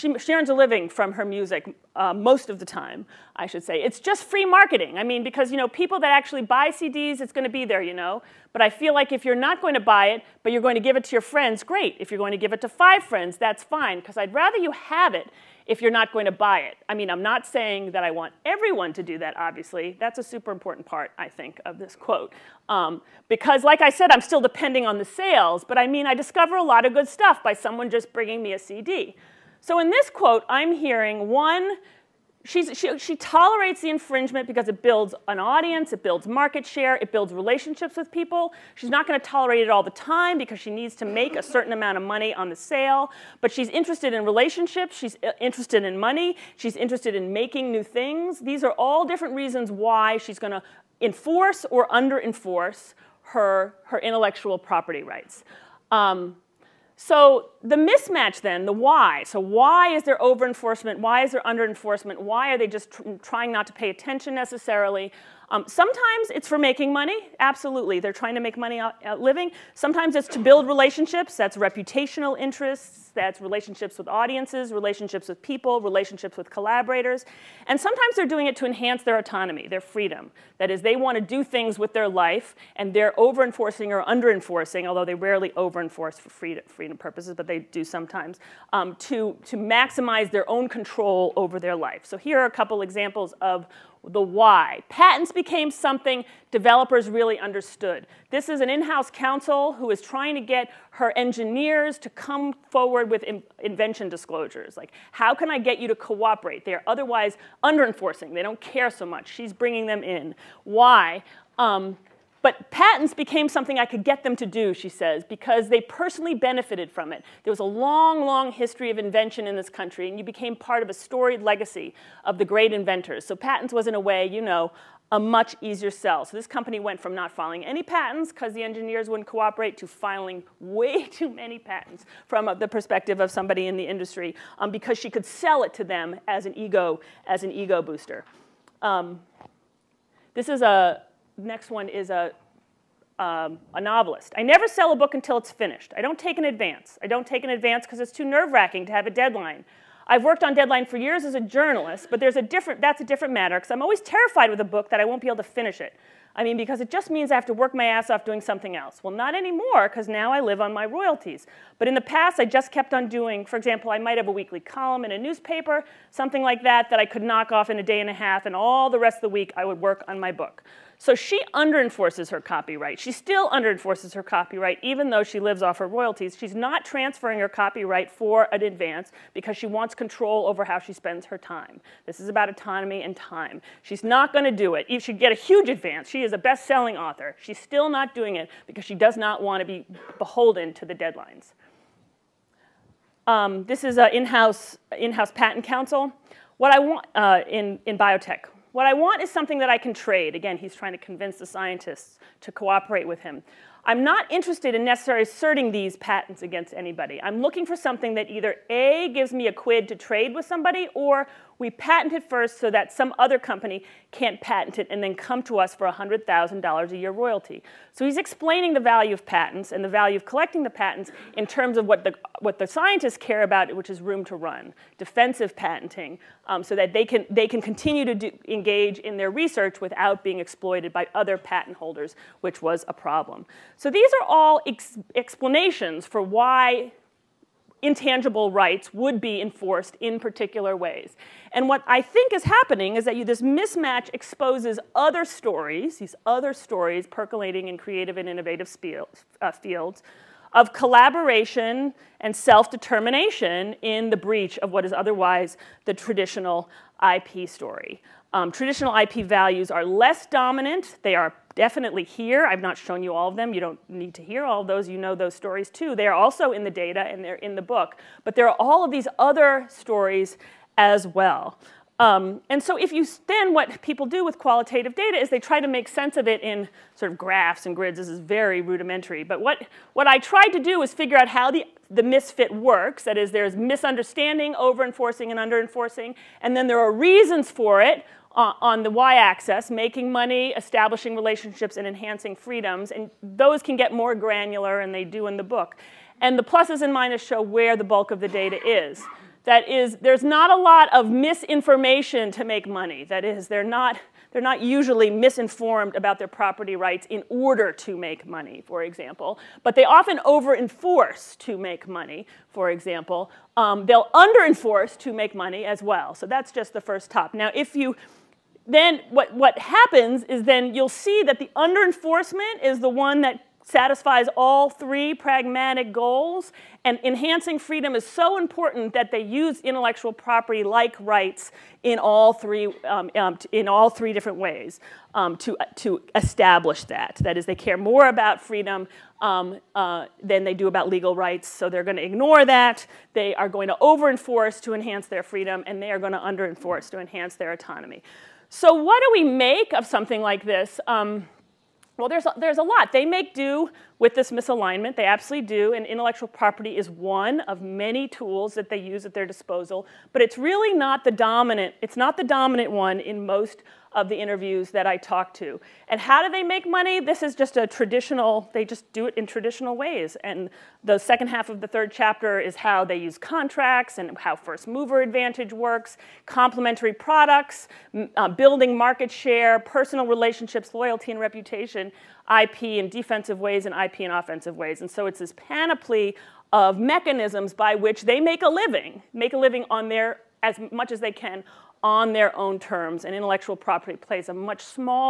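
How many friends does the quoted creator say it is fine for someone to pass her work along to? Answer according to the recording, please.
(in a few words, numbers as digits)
5.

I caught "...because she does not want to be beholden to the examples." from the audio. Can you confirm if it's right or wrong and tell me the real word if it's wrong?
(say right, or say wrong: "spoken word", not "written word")
wrong: "deadlines", not "examples".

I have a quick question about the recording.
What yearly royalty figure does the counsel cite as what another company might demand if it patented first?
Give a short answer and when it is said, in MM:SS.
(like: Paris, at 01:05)
$100,000, at 03:35.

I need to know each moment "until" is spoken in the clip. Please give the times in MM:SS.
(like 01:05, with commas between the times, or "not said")
02:25.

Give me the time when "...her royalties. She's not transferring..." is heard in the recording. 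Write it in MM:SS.
02:55.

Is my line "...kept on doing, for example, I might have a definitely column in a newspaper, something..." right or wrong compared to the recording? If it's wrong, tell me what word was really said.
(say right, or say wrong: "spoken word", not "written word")
wrong: "weekly", not "definitely".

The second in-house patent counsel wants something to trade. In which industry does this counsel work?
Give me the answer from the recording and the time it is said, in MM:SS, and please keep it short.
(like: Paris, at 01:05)
Biotech, at 03:17.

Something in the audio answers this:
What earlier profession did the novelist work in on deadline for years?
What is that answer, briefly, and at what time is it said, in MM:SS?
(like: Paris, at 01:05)
Journalist, at 02:31.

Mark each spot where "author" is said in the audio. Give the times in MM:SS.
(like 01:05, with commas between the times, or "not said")
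03:06.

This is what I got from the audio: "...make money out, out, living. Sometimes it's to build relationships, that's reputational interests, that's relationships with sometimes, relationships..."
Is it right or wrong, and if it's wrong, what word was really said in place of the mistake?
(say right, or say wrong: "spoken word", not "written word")
wrong: "audiences", not "sometimes".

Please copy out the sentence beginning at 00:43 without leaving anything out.
But she's interested in relationships, she's uh, interested in money, she's interested in making new things.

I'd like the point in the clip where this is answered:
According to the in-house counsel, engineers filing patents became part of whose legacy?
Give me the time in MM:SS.
02:02.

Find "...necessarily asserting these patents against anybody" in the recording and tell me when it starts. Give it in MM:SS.
03:24.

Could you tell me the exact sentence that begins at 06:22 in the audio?
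IP in defensive ways and IP in offensive ways.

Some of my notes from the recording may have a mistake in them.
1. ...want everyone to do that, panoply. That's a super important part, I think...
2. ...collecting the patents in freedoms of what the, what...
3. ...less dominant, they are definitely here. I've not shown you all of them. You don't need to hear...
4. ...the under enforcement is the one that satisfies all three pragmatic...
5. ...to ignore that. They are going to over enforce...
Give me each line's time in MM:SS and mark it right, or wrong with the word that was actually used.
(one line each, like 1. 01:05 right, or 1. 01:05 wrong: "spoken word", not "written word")
1. 00:18 wrong: "obviously", not "panoply"
2. 03:40 wrong: "terms", not "freedoms"
3. 04:19 right
4. 05:21 right
5. 05:41 right.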